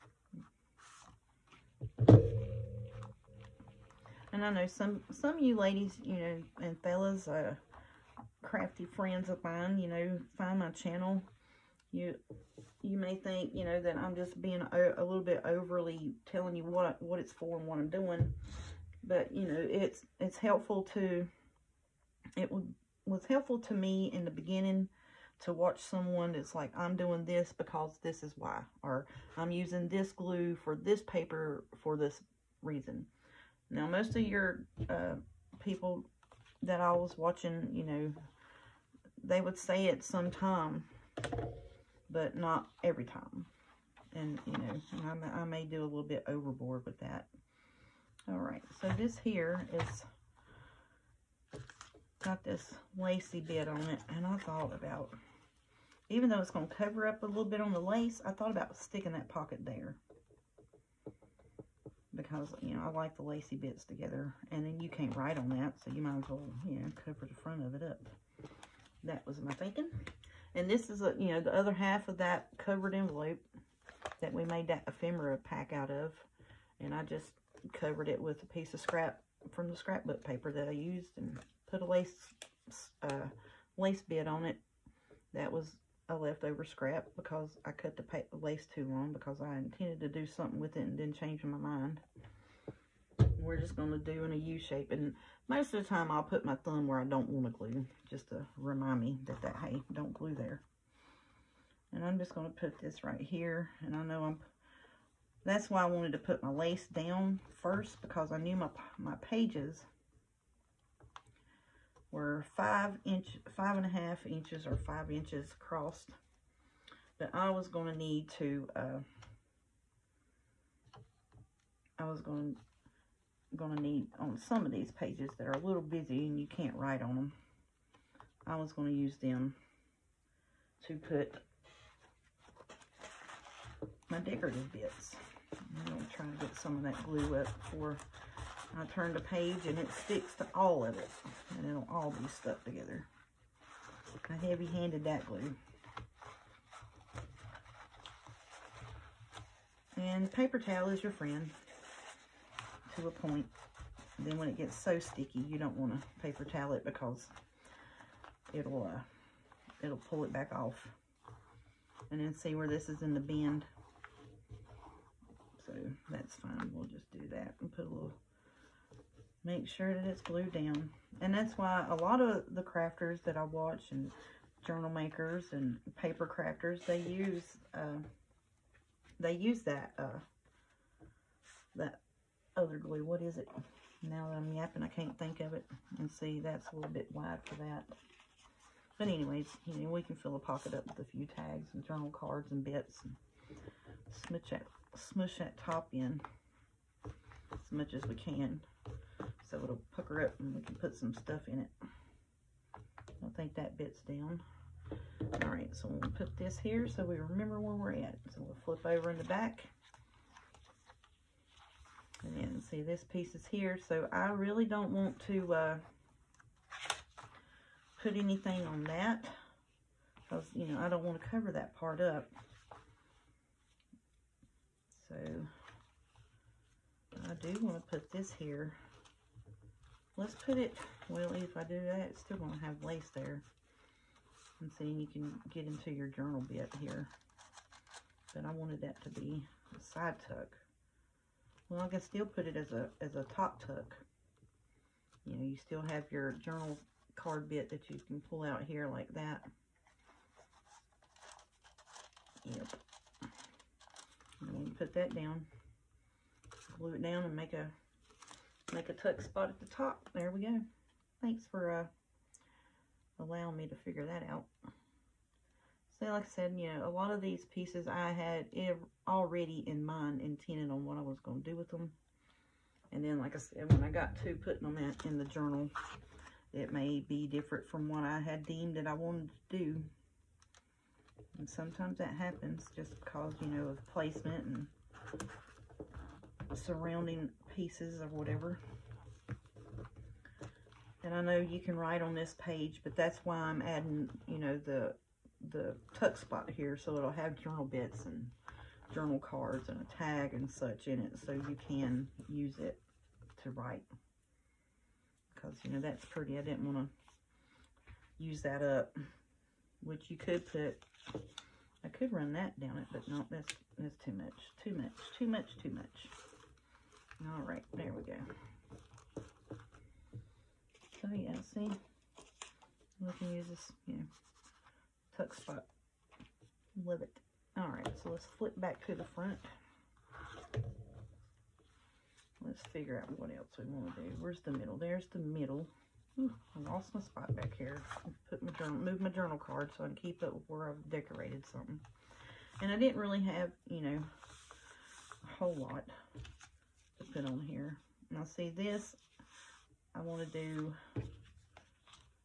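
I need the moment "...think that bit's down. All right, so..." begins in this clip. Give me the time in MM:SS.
03:23.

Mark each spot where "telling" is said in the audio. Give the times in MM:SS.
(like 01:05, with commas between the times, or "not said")
00:16.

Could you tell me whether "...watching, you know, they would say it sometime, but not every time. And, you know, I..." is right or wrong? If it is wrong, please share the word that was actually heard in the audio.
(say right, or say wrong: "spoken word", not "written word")
right.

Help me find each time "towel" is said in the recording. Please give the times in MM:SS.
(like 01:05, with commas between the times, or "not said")
02:30, 02:36.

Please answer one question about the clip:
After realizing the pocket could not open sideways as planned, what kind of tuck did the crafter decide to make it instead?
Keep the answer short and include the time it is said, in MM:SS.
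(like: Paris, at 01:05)
top tuck, at 04:03.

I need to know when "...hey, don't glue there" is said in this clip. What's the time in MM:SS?
01:39.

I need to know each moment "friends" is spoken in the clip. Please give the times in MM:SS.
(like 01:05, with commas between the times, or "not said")
00:08, 02:31.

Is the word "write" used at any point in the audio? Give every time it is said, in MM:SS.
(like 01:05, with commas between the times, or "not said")
01:05, 02:06, 04:51, 05:03.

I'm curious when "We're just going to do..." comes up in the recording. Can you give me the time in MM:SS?
01:33.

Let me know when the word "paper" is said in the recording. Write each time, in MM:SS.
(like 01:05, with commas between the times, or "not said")
00:31, 01:20, 02:30, 02:36, 02:55.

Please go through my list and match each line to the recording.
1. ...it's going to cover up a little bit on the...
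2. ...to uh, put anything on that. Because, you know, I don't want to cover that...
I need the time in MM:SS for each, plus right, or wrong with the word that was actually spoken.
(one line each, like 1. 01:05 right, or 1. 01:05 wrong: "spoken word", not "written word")
1. 00:56 right
2. 03:35 right.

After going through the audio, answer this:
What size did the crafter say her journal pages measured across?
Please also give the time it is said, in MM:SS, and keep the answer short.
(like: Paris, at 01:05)
5 and a half inches, at 01:53.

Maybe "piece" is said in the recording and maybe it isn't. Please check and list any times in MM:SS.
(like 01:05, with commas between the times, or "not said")
01:18, 03:33, 04:27, 04:47.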